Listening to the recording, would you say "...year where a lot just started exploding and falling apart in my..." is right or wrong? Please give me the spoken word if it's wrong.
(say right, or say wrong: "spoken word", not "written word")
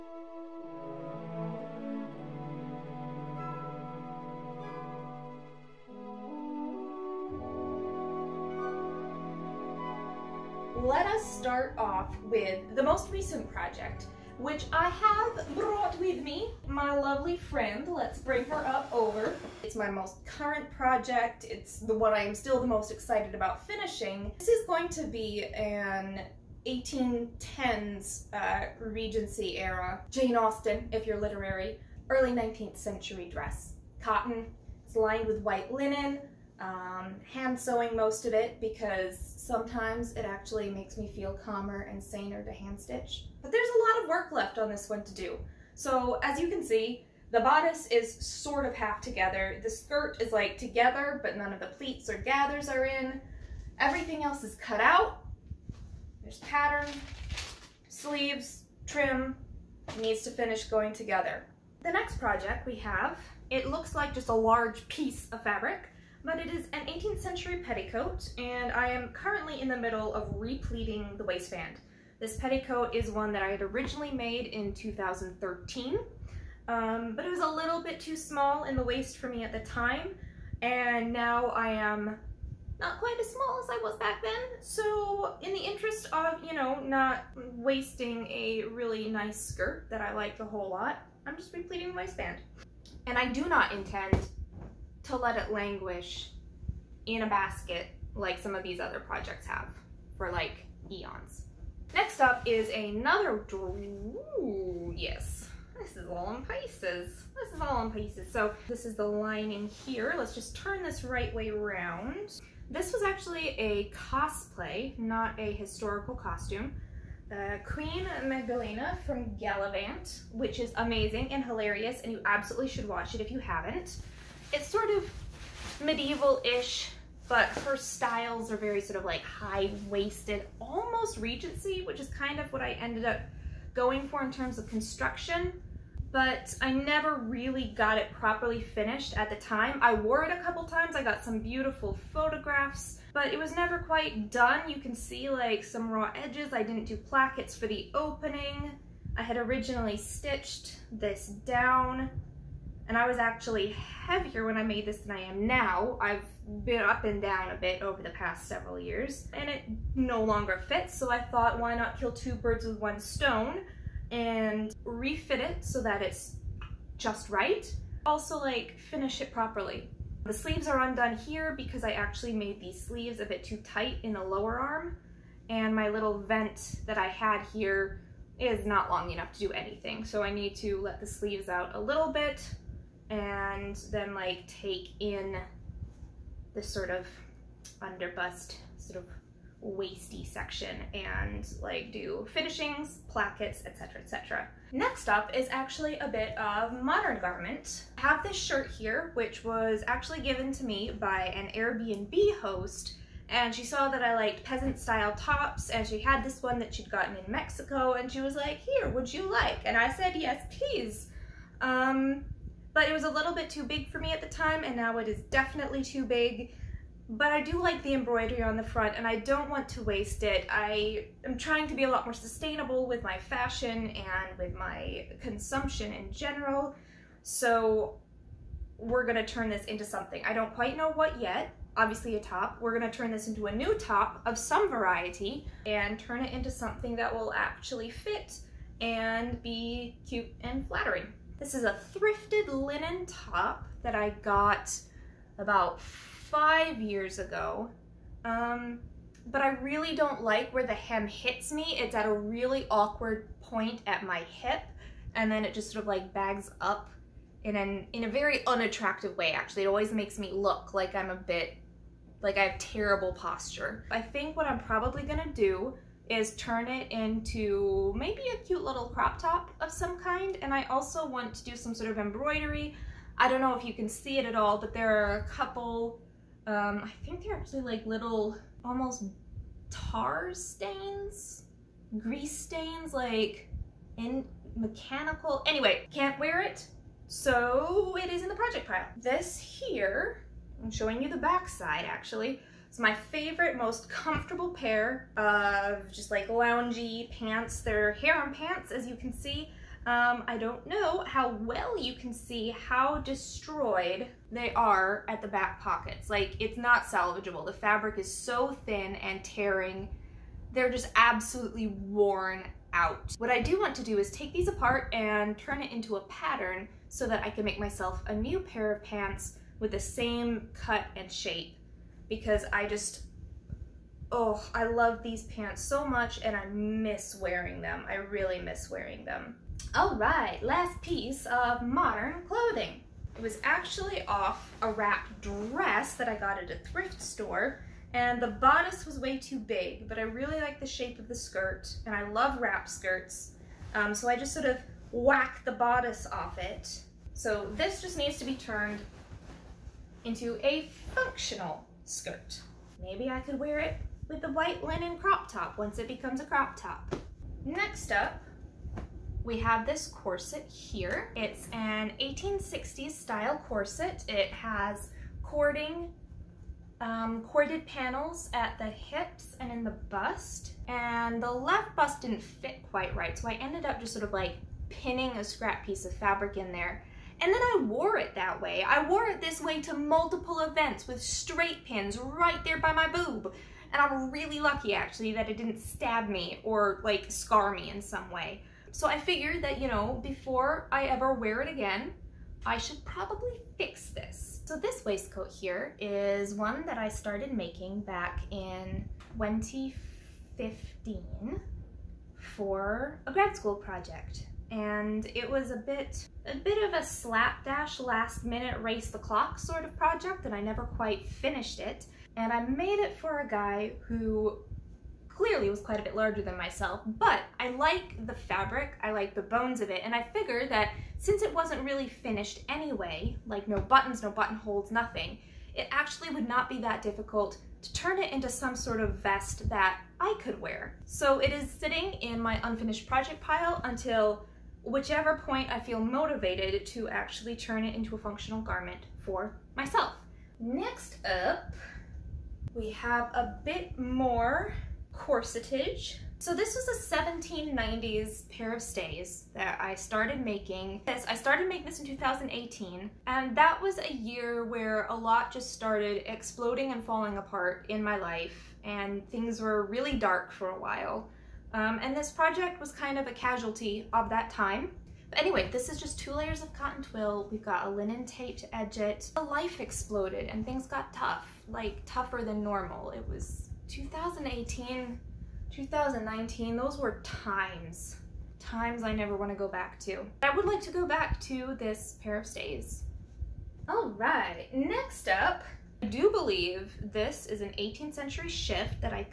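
right.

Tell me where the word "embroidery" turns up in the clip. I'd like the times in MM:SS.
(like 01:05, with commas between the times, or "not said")
03:37, 04:31.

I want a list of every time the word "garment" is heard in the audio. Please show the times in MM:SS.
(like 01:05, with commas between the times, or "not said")
03:17, 07:18.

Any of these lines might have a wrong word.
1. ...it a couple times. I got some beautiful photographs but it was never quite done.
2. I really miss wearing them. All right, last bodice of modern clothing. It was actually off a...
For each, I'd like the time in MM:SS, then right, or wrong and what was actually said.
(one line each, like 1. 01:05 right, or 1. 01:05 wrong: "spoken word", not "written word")
1. 02:20 right
2. 05:27 wrong: "piece", not "bodice".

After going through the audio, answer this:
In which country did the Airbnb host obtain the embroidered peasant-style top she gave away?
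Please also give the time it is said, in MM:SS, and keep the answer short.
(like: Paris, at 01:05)
Mexico, at 03:27.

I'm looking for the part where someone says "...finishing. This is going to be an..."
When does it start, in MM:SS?
00:23.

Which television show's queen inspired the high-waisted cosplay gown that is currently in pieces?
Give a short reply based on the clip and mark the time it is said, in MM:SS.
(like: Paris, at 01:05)
Galavant, at 01:59.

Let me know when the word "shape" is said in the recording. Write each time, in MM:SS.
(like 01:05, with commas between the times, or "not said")
05:21, 05:40.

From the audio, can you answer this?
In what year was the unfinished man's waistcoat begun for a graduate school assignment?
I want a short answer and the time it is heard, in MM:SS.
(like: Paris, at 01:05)
2015, at 06:39.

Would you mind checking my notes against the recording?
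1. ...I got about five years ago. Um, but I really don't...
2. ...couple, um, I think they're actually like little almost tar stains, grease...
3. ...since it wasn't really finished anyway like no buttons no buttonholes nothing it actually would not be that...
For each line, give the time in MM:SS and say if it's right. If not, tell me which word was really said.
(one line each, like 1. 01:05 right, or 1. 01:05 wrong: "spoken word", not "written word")
1. 04:03 right
2. 04:35 right
3. 07:00 right.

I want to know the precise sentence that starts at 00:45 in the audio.
So as you can see, the bodice is sort of half together.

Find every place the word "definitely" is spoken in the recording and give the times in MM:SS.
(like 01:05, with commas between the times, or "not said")
03:35.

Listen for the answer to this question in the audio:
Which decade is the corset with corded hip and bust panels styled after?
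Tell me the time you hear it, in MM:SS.
06:01.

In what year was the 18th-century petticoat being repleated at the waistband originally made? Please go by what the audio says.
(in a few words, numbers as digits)
2013.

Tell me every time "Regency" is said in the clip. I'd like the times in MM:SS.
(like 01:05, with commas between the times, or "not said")
00:28, 02:11.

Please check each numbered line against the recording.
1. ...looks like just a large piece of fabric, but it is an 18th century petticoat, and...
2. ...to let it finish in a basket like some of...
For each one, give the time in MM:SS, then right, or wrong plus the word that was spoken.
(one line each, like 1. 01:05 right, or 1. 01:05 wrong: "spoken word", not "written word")
1. 01:03 right
2. 01:35 wrong: "languish", not "finish".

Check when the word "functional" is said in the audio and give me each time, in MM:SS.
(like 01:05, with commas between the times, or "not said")
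05:50, 07:17.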